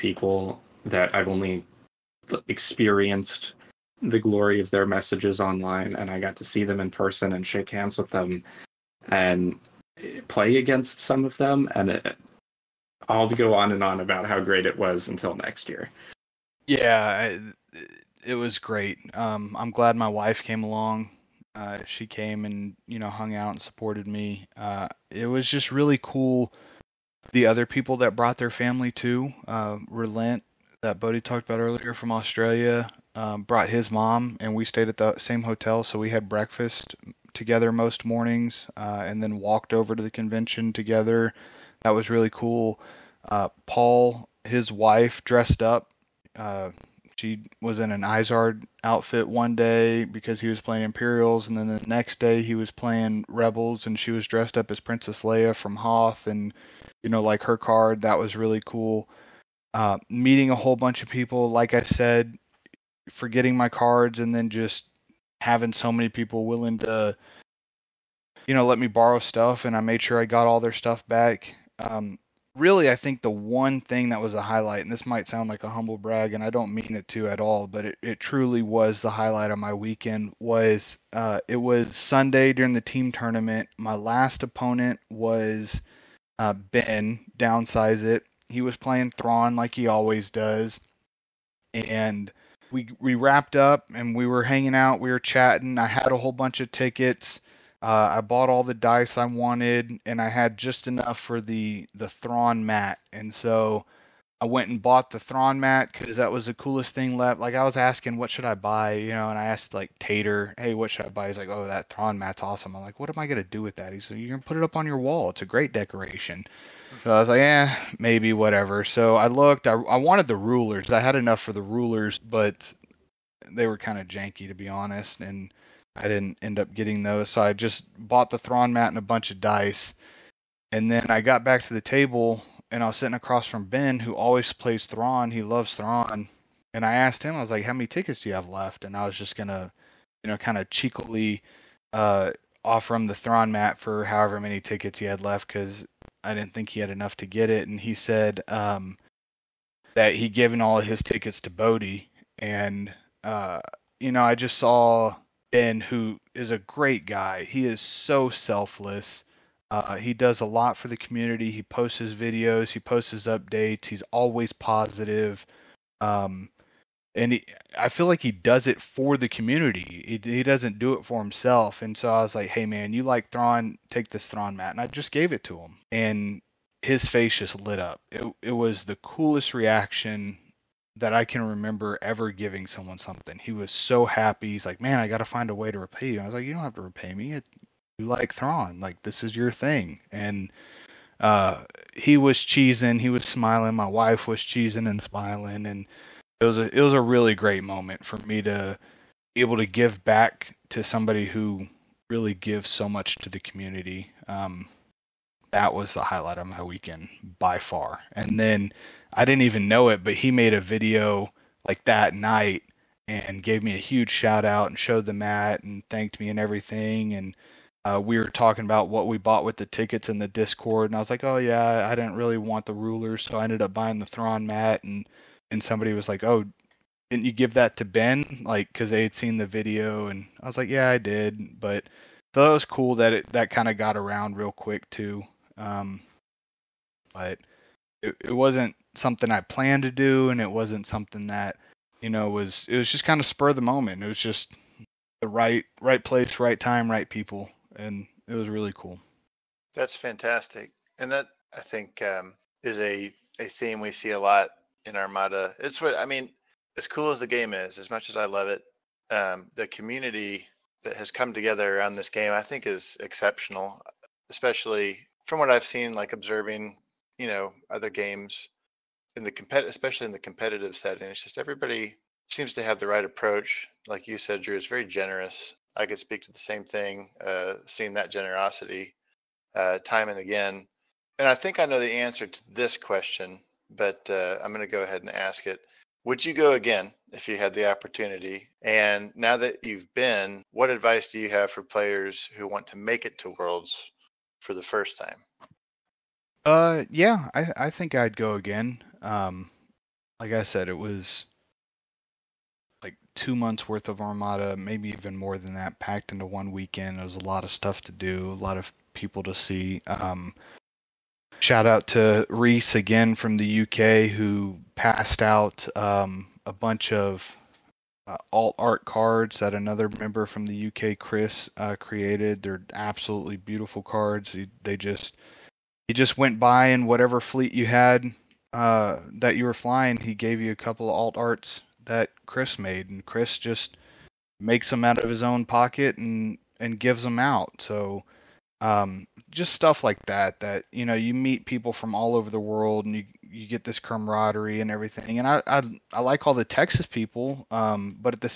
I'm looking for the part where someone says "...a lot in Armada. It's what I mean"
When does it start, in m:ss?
4:14.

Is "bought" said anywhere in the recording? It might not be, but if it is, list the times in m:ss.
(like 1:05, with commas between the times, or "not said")
1:38, 1:44, 2:07, 3:39.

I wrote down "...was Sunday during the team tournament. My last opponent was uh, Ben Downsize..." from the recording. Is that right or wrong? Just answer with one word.
right.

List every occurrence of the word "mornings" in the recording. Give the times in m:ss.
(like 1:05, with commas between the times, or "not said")
0:38.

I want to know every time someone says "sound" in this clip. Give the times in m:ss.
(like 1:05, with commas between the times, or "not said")
1:15.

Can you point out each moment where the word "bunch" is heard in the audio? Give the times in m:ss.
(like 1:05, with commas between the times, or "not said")
1:00, 1:36, 2:09, 5:16.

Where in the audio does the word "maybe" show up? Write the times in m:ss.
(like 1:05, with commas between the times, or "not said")
1:57, 5:04.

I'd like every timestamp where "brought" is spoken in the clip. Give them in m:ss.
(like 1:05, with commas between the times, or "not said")
0:28, 0:33.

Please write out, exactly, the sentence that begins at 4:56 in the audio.
Uh, yeah, I I think I'd go again.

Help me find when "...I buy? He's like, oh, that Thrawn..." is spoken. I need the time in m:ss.
1:51.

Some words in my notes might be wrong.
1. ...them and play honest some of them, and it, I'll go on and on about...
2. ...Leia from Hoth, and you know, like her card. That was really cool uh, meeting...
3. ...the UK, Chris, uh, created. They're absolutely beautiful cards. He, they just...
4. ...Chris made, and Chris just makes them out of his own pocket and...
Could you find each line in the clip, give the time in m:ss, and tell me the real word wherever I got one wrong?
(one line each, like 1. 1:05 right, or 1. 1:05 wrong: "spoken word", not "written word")
1. 0:08 wrong: "against", not "honest"
2. 0:55 right
3. 5:20 right
4. 5:32 right.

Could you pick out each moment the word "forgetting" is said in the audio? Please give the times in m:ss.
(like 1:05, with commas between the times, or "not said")
1:03.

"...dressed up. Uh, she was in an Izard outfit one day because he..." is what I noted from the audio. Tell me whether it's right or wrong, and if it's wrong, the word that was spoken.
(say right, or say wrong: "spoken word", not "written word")
right.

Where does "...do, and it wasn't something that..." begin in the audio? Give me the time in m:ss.
3:59.